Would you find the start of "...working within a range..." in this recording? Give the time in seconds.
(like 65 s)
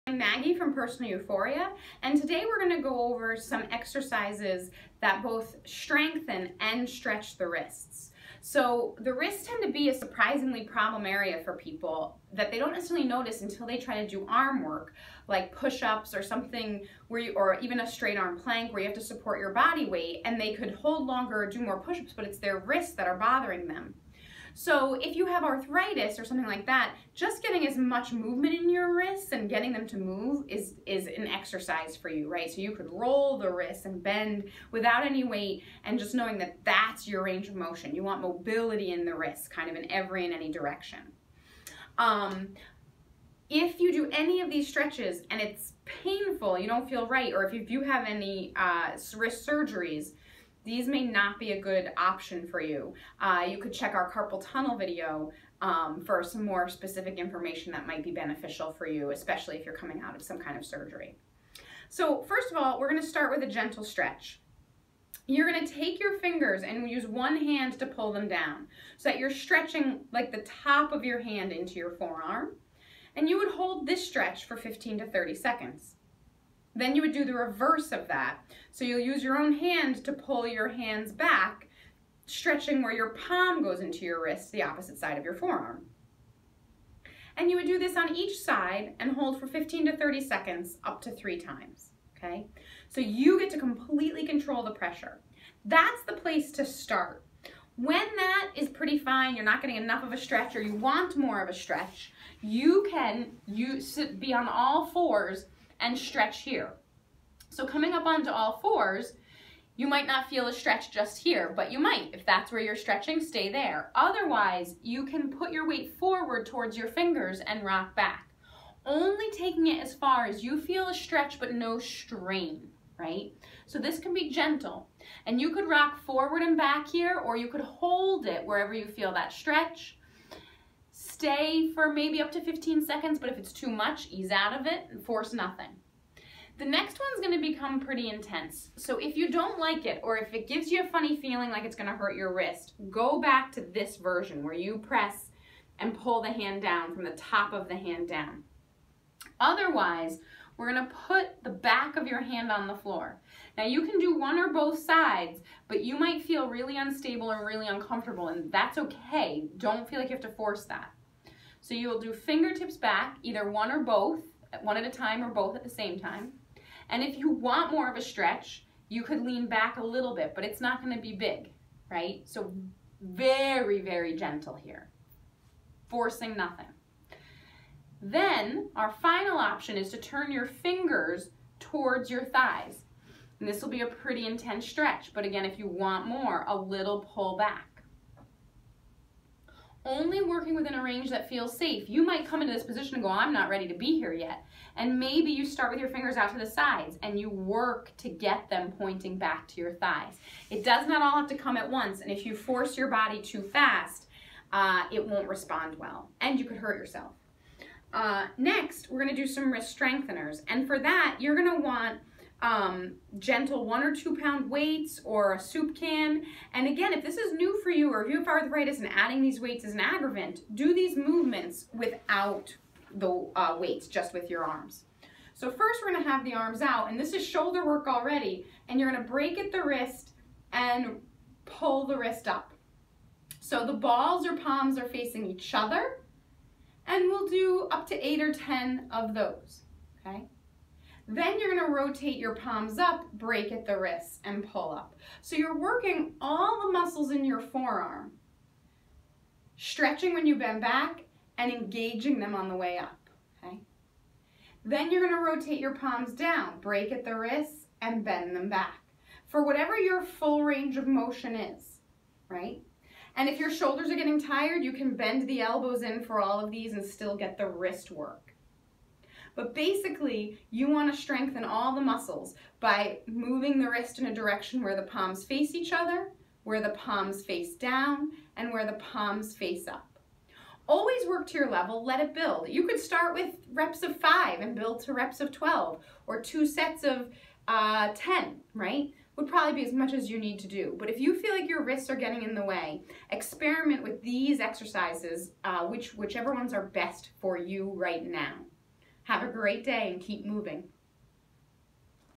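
190 s.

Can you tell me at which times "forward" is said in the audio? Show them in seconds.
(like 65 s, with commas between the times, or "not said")
115 s, 126 s.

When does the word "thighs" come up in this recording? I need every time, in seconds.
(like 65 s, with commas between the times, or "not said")
182 s, 199 s.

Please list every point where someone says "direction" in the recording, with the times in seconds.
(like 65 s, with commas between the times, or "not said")
40 s, 274 s.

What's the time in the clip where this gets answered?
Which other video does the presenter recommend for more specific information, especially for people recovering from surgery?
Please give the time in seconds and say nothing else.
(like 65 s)
54 s.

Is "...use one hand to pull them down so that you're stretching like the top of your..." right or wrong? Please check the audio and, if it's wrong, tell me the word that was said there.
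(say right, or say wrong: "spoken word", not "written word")
right.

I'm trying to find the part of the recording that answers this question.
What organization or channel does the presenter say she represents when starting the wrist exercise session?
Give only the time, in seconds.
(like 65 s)
0 s.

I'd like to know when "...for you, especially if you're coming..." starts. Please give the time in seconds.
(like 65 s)
58 s.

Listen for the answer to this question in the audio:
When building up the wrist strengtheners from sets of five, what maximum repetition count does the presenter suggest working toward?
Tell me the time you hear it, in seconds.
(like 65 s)
285 s.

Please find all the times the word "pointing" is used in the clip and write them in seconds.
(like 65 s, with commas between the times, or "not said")
198 s.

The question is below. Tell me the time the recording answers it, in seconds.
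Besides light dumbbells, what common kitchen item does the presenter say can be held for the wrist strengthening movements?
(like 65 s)
215 s.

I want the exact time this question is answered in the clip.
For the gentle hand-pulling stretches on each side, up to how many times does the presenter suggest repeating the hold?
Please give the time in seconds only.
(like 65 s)
91 s.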